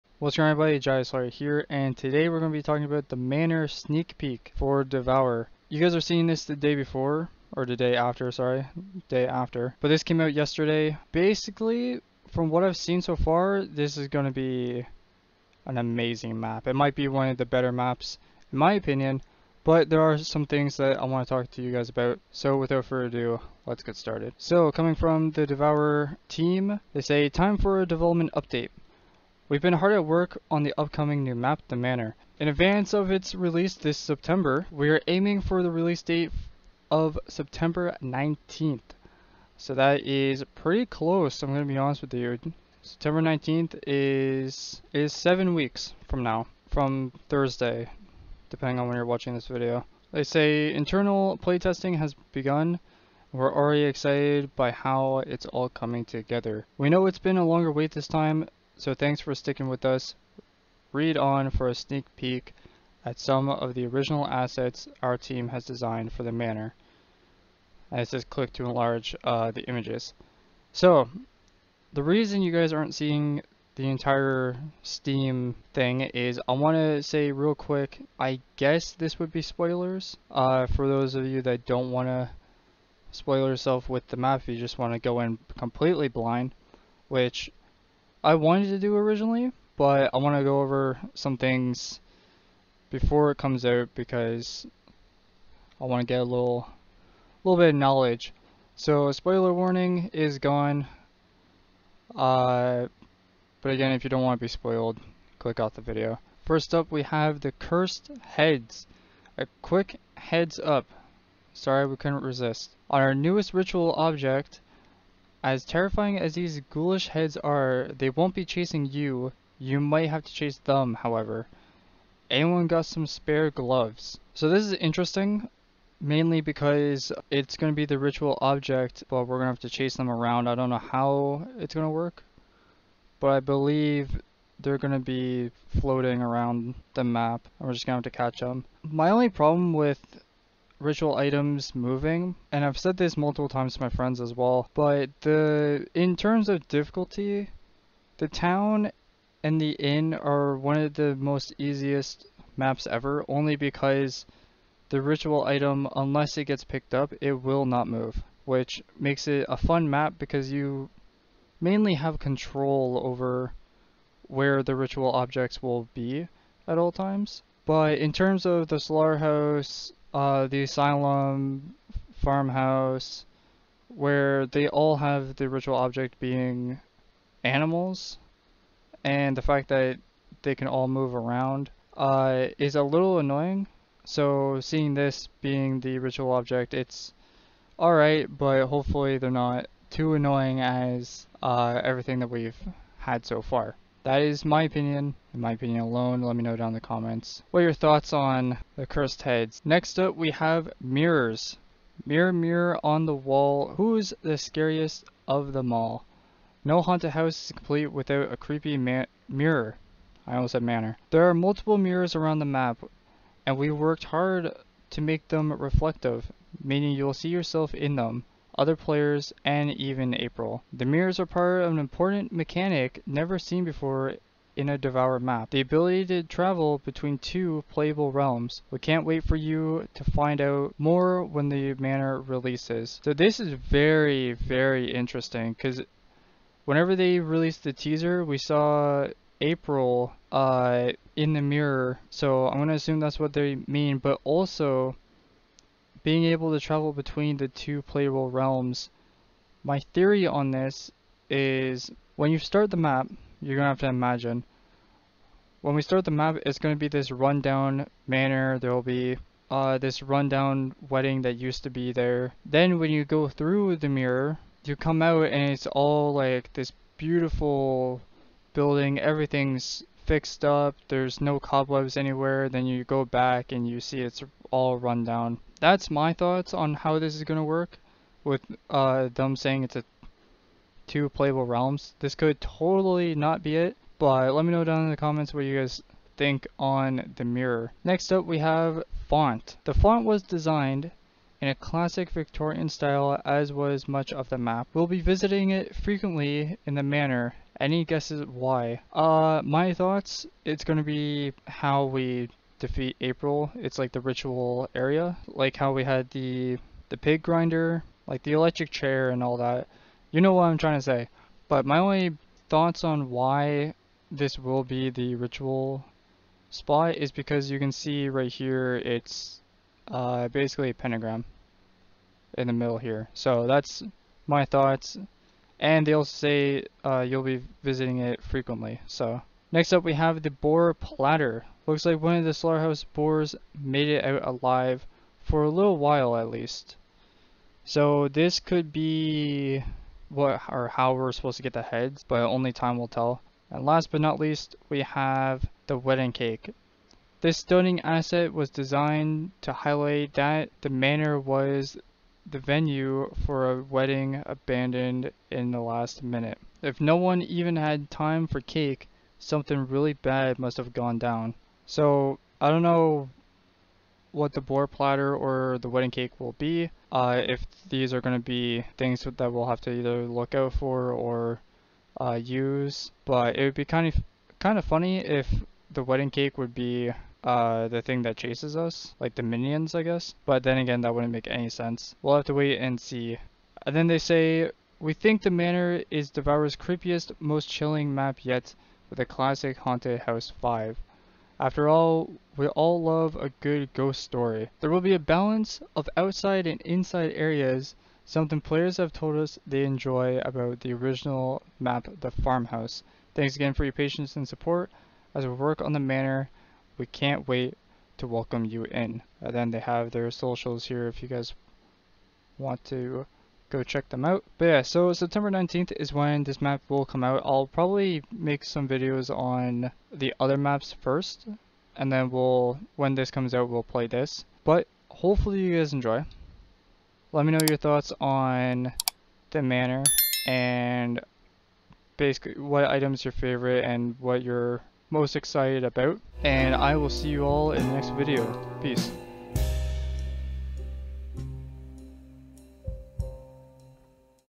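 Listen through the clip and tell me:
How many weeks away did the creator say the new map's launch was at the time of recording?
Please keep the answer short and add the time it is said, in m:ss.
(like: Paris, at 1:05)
7, at 0:45.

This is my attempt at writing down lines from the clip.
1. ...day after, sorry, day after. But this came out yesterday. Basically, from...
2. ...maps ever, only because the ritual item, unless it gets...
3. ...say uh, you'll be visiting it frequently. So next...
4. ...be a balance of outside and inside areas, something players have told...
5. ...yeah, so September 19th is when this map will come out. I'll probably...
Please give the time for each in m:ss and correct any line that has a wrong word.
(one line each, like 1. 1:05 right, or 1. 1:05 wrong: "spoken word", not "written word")
1. 0:07 right
2. 2:32 right
3. 5:26 right
4. 6:34 right
5. 6:54 right.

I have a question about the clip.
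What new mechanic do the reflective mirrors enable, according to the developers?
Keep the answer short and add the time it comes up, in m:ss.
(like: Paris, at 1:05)
Travel between two playable realms, at 3:46.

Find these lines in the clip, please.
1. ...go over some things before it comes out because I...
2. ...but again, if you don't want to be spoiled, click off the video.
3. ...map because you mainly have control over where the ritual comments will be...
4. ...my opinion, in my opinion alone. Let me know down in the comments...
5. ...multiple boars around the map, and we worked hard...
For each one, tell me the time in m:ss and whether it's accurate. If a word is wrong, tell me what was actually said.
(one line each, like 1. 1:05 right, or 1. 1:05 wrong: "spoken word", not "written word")
1. 1:30 right
2. 1:43 right
3. 2:39 wrong: "objects", not "comments"
4. 3:14 right
5. 3:31 wrong: "mirrors", not "boars".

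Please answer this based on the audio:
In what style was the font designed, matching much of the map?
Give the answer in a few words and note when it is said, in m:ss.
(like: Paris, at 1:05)
Victorian, at 4:52.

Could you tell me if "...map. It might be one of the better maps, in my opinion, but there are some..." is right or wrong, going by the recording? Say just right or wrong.
right.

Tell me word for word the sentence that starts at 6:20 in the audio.
But then again, that wouldn't make any sense.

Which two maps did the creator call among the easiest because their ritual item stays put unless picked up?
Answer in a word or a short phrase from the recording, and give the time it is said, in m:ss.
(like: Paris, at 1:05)
The town and the inn, at 2:28.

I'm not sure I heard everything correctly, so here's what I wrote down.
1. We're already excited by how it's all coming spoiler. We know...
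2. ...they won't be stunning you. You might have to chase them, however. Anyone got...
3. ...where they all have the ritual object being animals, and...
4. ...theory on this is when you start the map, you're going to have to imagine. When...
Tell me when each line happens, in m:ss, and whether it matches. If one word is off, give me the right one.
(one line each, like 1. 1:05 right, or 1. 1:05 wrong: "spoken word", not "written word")
1. 0:53 wrong: "together", not "spoiler"
2. 1:57 wrong: "chasing", not "stunning"
3. 2:53 right
4. 4:09 right.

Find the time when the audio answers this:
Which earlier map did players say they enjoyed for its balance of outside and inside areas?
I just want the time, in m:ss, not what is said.
6:42.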